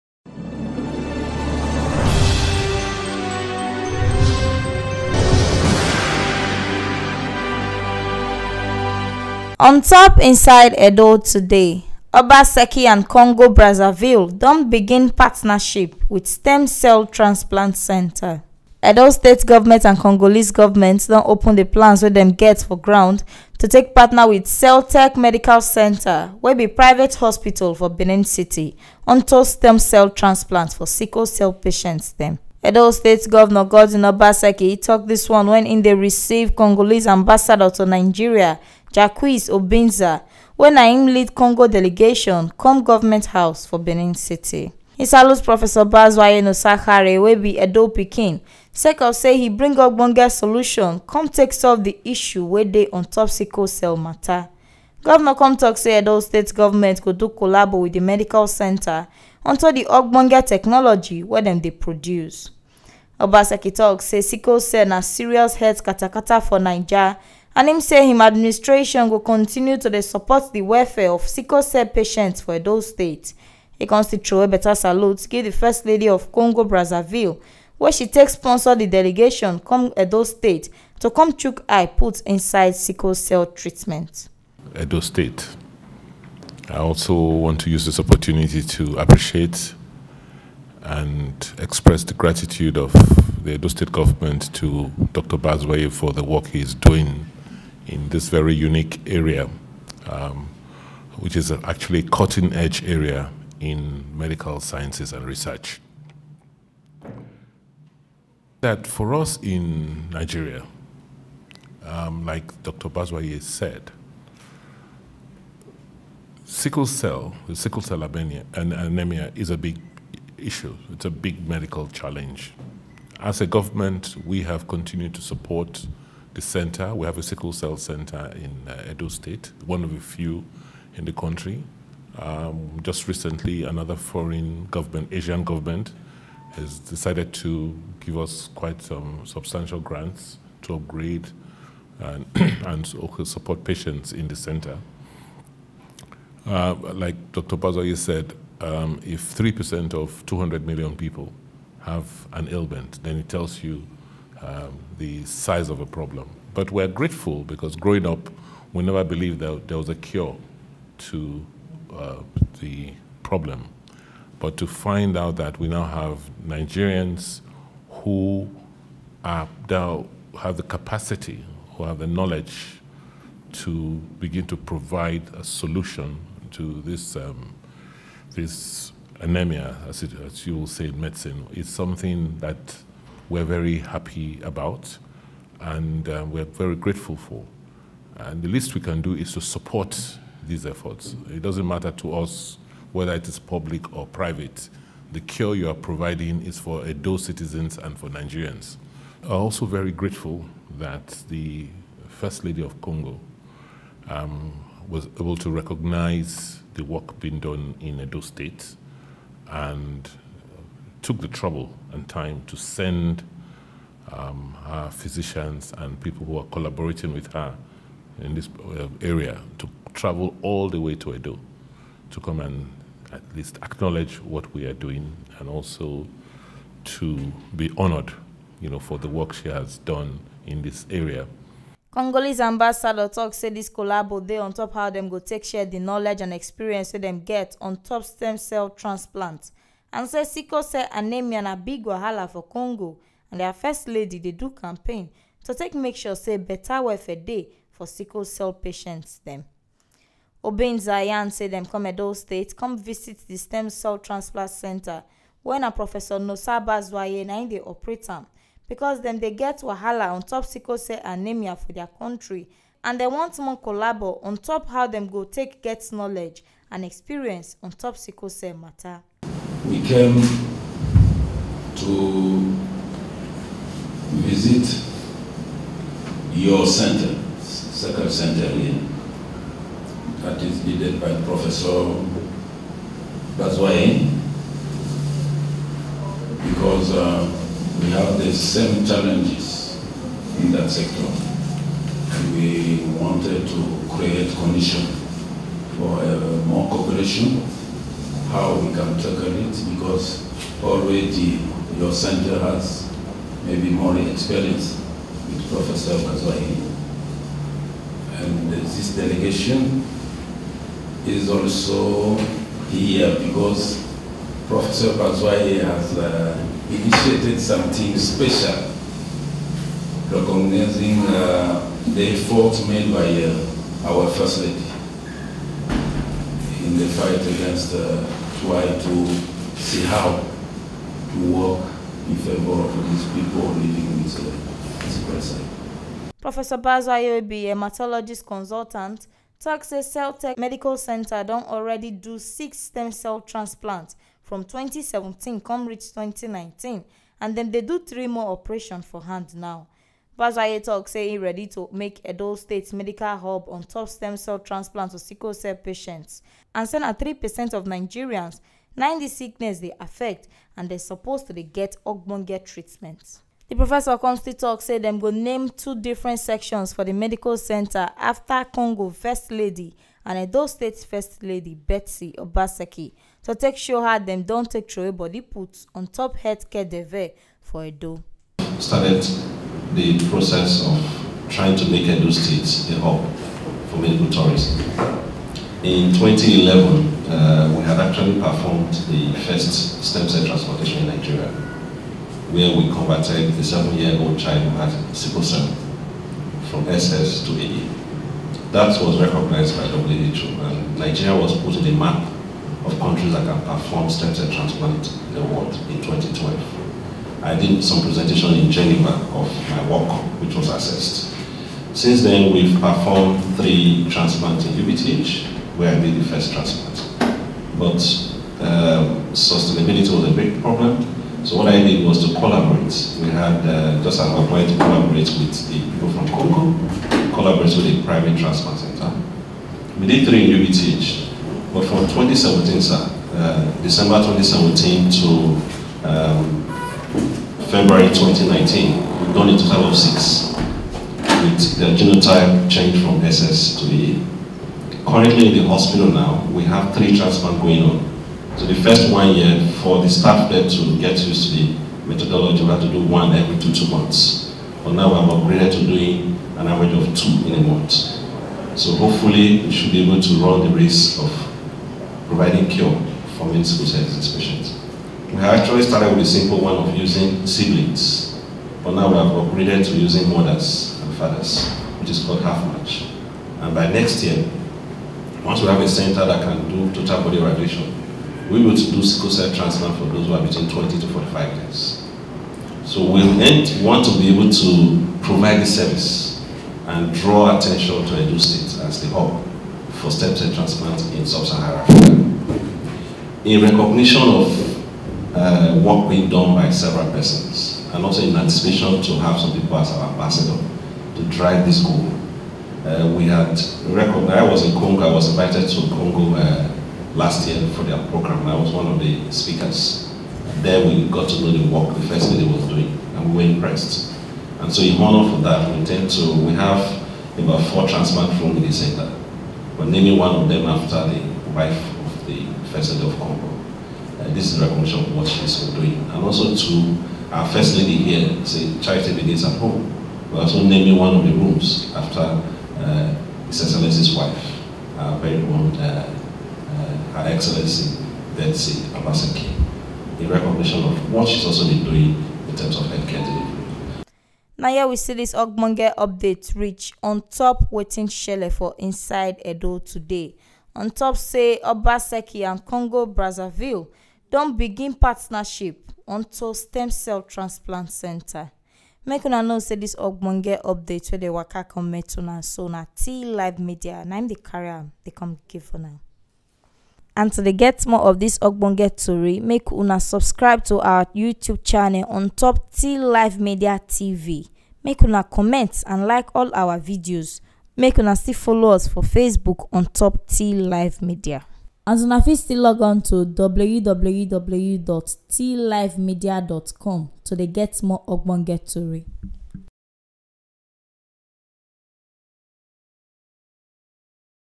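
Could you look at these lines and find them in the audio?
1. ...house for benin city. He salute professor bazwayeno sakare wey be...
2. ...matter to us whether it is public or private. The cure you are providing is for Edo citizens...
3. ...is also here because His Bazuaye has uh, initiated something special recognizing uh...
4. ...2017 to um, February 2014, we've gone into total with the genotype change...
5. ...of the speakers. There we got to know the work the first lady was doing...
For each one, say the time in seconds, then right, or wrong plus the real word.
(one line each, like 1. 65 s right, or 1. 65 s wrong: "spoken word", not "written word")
1. 43 s right
2. 191 s right
3. 311 s wrong: "Professor", not "His"
4. 433 s wrong: "2019", not "2014"
5. 508 s right.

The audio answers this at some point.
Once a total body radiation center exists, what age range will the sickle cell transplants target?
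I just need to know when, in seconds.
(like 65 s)
480 s.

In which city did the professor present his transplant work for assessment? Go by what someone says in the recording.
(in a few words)
Geneva.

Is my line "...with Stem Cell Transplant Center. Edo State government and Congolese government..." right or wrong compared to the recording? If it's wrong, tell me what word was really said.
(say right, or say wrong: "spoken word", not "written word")
right.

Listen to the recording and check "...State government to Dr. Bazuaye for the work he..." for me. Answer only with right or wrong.
right.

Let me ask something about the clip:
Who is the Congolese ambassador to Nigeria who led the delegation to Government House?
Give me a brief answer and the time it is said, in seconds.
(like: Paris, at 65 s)
Jacques Obinza, at 38 s.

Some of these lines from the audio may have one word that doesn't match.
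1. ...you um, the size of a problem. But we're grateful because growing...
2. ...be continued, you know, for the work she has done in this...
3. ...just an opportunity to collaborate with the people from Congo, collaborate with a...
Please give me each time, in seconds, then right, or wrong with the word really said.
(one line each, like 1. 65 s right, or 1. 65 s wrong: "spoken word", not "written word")
1. 153 s right
2. 227 s wrong: "honored", not "continued"
3. 423 s right.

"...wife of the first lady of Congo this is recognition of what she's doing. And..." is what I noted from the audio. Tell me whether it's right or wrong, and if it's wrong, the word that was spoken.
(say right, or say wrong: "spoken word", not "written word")
right.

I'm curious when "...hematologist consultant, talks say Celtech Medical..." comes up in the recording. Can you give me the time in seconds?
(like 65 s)
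337 s.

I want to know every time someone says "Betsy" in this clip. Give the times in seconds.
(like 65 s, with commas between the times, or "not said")
371 s, 538 s.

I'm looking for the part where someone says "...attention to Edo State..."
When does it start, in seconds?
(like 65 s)
487 s.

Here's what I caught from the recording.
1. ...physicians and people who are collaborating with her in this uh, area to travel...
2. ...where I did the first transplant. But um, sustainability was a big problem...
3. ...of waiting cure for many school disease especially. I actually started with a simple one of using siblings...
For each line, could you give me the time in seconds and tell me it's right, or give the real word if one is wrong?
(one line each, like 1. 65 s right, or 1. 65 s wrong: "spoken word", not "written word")
1. 214 s right
2. 415 s right
3. 461 s wrong: "providing", not "waiting".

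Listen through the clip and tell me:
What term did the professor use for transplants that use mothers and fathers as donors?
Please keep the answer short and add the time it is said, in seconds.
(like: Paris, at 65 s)
half match, at 472 s.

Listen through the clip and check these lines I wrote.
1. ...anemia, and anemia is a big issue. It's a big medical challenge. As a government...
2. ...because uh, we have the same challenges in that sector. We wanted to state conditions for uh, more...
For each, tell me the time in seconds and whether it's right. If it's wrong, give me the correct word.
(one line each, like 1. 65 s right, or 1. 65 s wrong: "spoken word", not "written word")
1. 118 s right
2. 286 s wrong: "create", not "state".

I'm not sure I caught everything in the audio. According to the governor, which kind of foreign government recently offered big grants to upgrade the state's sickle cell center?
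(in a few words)
Asian government.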